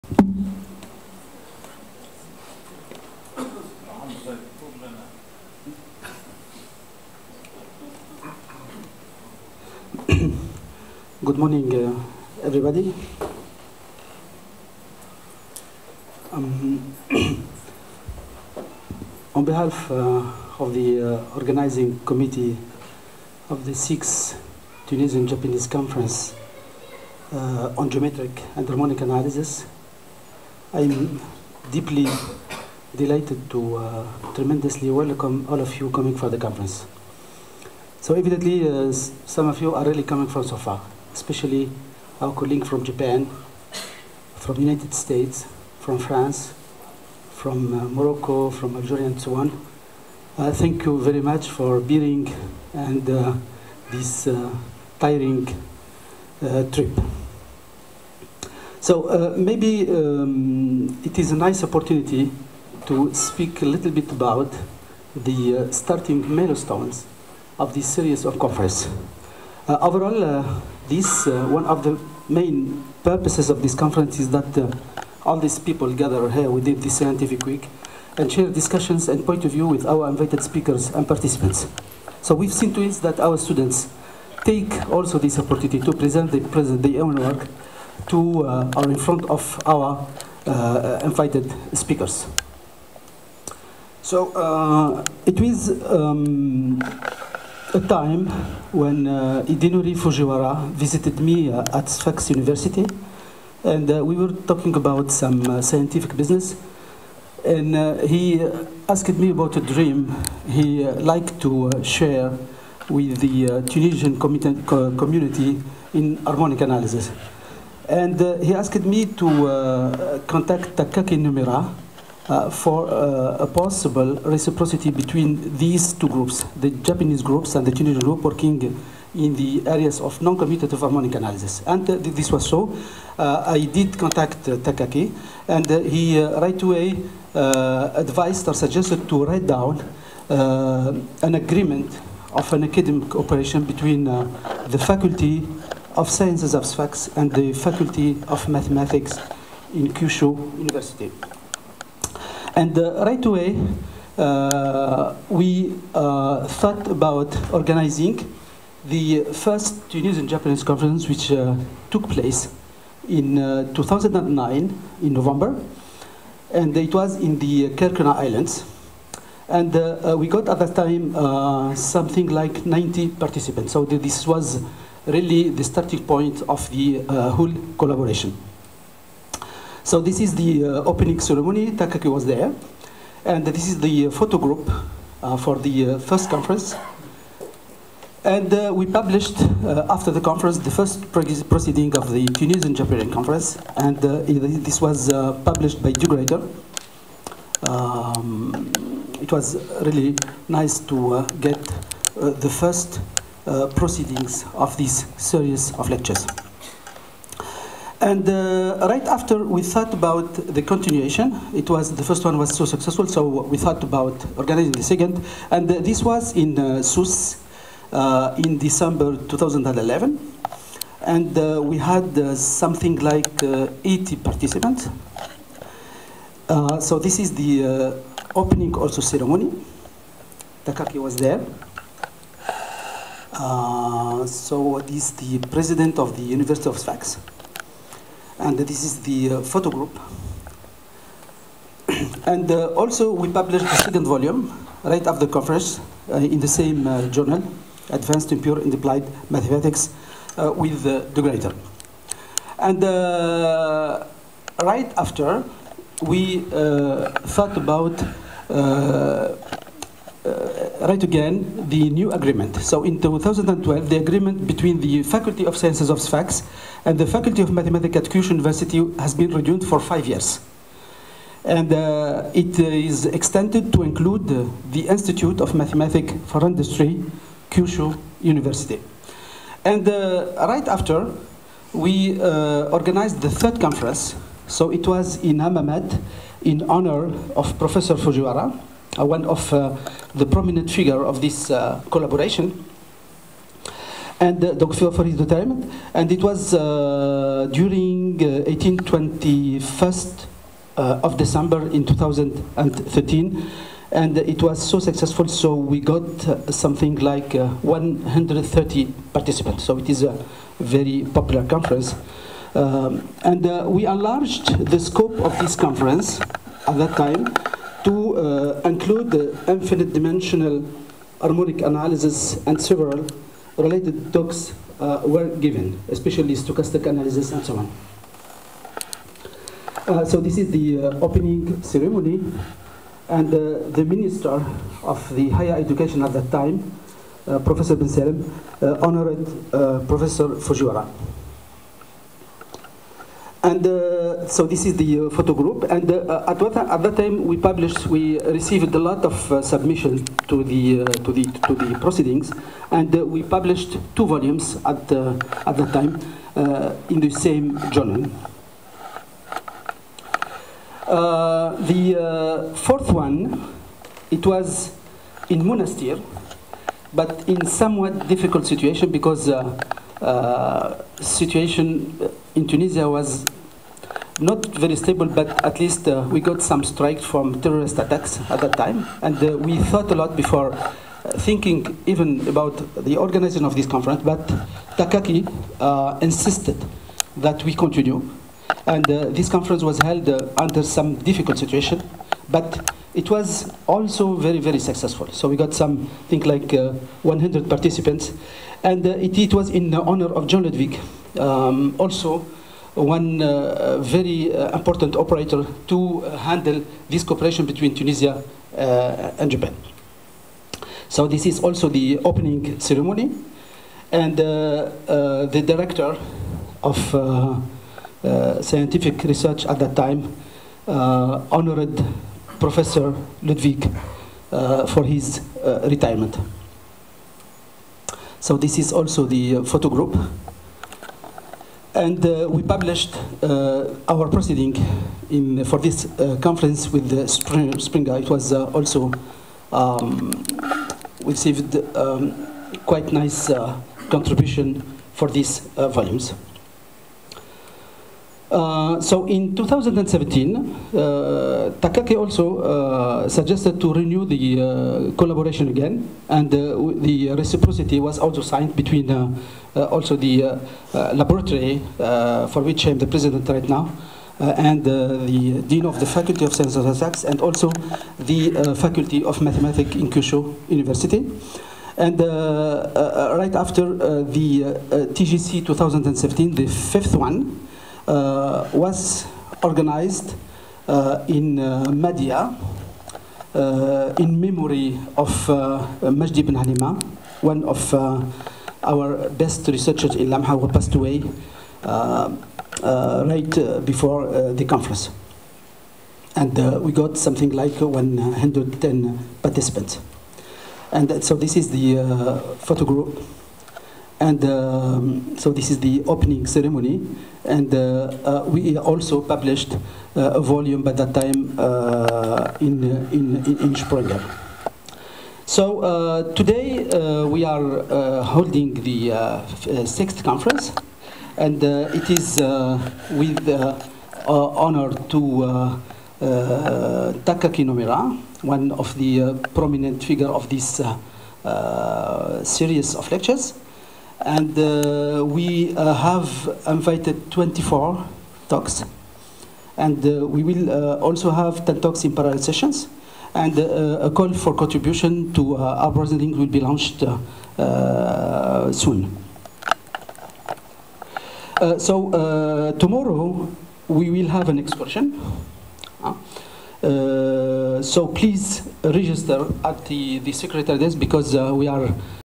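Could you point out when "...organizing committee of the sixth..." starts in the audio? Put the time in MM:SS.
00:21.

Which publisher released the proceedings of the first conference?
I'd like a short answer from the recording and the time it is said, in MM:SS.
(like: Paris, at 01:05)
De Gruyter, at 03:15.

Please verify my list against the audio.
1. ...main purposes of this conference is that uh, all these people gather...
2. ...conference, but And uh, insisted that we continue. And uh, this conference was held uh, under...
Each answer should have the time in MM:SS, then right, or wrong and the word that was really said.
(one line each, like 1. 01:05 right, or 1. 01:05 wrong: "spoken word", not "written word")
1. 01:12 right
2. 06:23 wrong: "Takaaki", not "And".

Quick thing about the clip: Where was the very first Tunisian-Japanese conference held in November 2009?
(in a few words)
Kerkennah Islands.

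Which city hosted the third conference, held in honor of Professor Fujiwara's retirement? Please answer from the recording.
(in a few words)
Hammamet.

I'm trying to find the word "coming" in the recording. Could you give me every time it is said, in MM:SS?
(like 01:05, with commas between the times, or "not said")
00:35, 00:40.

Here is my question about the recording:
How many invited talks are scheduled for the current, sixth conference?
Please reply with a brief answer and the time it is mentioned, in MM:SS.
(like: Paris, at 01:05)
24, at 08:57.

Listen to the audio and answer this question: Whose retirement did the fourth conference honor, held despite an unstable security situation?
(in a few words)
Jean Ludwig.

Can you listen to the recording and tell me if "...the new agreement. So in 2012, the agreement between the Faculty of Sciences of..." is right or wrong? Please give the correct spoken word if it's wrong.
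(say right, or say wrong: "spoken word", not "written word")
right.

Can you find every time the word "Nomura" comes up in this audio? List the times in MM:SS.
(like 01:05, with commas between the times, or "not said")
02:01, 08:47.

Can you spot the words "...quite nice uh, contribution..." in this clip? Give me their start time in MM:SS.
07:22.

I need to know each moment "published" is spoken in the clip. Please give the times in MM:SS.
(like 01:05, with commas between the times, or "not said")
03:08, 03:15, 04:03, 05:47, 05:53, 07:12, 08:29.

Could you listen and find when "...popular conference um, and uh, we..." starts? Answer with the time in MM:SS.
05:11.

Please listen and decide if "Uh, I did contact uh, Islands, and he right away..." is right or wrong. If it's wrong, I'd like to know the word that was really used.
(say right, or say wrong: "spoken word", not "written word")
wrong: "Takaaki", not "Islands".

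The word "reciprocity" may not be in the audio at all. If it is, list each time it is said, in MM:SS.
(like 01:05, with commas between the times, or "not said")
02:04, 07:37.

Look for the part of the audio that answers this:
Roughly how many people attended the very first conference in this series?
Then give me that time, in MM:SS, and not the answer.
02:52.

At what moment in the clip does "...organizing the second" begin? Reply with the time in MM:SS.
03:34.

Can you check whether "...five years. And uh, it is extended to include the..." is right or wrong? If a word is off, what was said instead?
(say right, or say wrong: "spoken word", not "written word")
right.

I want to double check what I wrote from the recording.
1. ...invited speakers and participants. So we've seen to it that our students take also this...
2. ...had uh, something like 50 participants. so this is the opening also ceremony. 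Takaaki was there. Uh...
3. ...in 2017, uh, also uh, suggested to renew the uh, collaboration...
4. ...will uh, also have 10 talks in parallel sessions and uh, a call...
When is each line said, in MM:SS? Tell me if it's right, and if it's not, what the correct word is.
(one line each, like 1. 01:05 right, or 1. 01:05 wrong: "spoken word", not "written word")
1. 01:20 right
2. 03:41 wrong: "80", not "50"
3. 07:29 right
4. 09:00 right.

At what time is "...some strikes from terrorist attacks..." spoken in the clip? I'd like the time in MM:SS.
06:16.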